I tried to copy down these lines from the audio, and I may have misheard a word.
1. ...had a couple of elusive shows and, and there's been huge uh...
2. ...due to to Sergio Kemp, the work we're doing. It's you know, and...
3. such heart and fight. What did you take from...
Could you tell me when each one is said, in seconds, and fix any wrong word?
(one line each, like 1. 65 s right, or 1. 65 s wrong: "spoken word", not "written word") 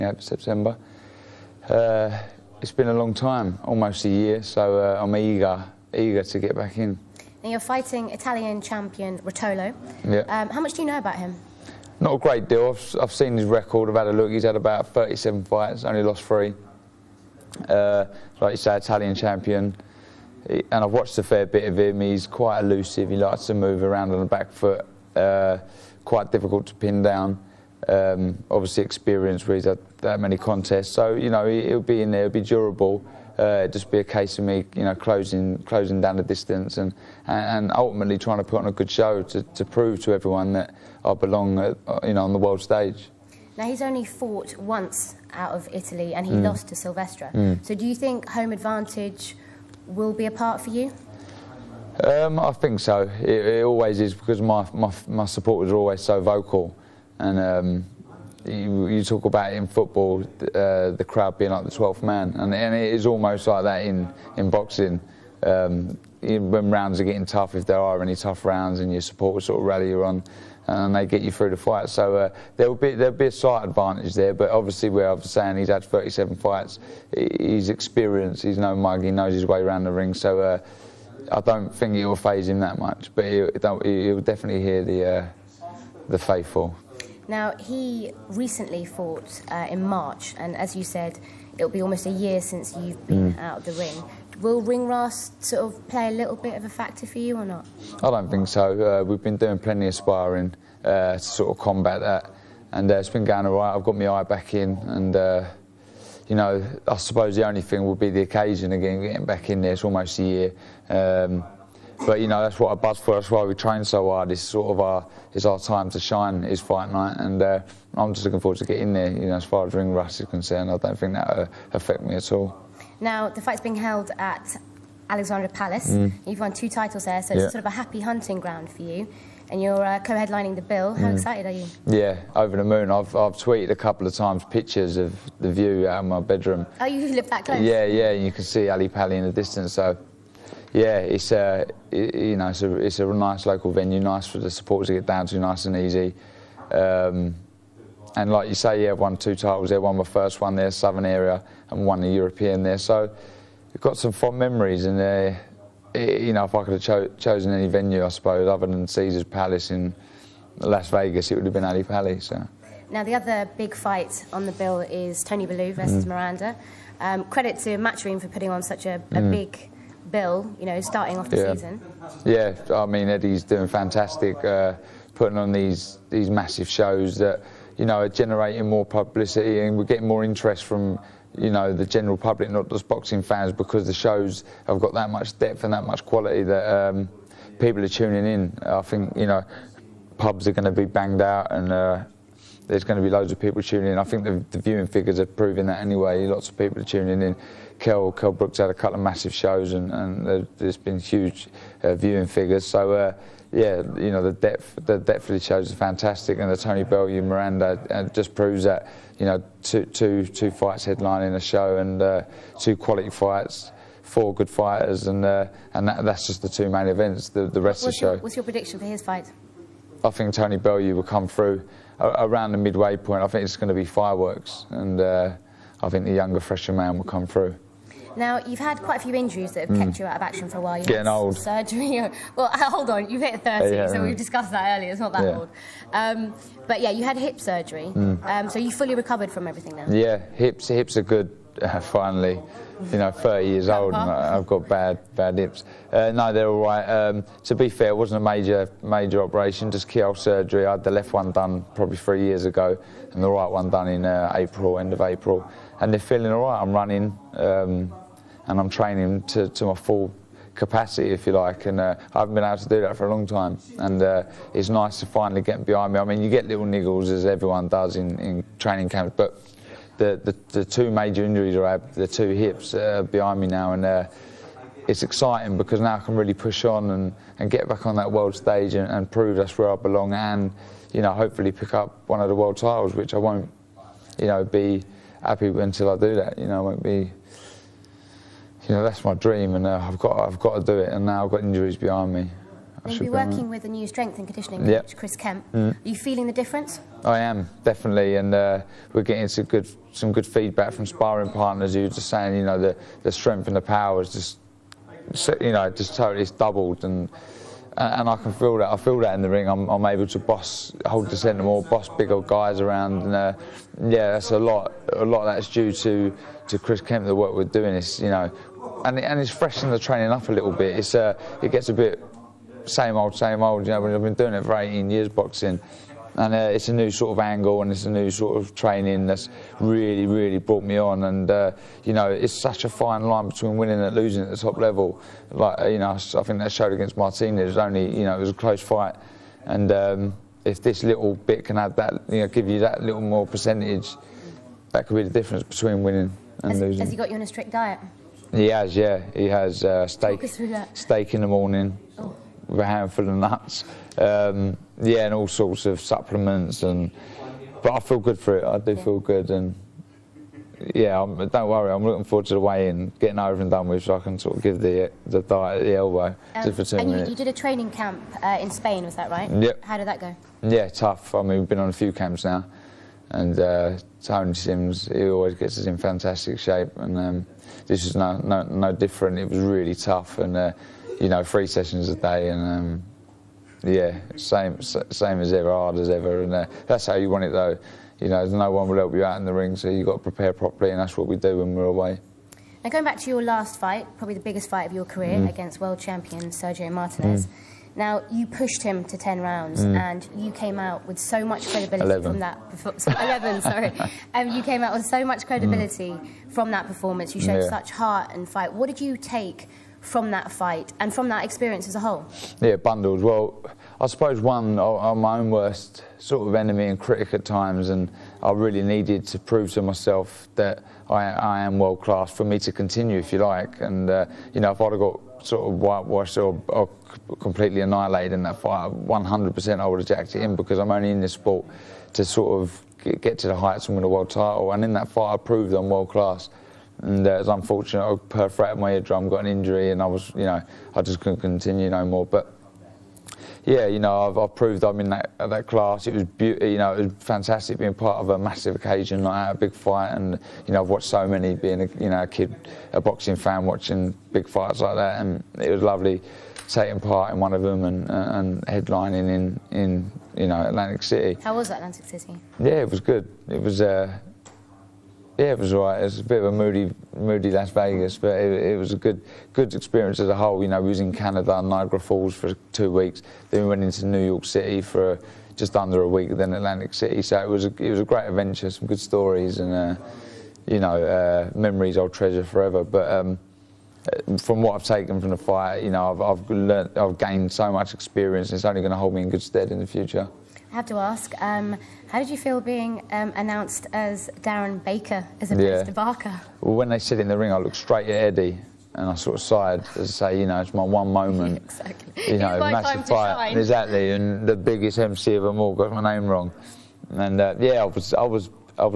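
1. 198 s wrong: "massive", not "elusive"
2. 315 s wrong: "Chris", not "Sergio"
3. 407 s right.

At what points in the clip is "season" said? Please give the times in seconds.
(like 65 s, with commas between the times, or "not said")
171 s.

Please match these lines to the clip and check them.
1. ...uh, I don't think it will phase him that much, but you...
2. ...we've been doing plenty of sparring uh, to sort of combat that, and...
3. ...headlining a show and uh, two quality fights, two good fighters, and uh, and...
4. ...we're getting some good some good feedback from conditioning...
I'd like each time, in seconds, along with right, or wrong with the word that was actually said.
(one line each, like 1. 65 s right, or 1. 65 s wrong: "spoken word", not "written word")
1. 80 s right
2. 99 s right
3. 210 s wrong: "four", not "two"
4. 298 s wrong: "sparring", not "conditioning".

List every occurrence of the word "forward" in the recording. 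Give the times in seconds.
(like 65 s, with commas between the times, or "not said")
118 s, 362 s.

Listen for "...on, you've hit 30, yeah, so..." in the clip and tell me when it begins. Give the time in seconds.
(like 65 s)
232 s.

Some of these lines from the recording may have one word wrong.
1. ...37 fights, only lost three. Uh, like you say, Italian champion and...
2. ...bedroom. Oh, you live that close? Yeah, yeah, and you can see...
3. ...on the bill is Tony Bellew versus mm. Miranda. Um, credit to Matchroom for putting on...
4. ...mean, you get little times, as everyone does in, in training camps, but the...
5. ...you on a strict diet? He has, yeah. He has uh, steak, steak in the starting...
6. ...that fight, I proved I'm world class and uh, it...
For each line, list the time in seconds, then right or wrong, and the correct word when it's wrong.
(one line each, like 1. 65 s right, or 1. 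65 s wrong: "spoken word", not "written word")
1. 14 s right
2. 136 s right
3. 164 s right
4. 266 s wrong: "niggles", not "times"
5. 347 s wrong: "morning", not "starting"
6. 434 s right.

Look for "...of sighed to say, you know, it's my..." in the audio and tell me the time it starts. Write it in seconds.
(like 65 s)
499 s.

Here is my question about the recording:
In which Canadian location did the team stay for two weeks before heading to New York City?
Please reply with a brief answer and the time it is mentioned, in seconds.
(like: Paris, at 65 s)
Niagara Falls, at 471 s.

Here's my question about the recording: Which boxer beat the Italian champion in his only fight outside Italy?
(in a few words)
Silvestre.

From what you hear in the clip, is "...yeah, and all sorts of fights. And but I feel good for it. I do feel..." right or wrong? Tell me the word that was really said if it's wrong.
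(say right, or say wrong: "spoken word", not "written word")
wrong: "supplements", not "fights".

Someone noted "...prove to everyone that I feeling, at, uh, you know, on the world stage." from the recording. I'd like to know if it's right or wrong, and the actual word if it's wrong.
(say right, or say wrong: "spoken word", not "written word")
wrong: "belong", not "feeling".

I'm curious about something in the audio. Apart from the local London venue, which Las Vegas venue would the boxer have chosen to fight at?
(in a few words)
Caesar's Palace.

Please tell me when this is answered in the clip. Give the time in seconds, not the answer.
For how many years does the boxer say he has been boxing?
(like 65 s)
324 s.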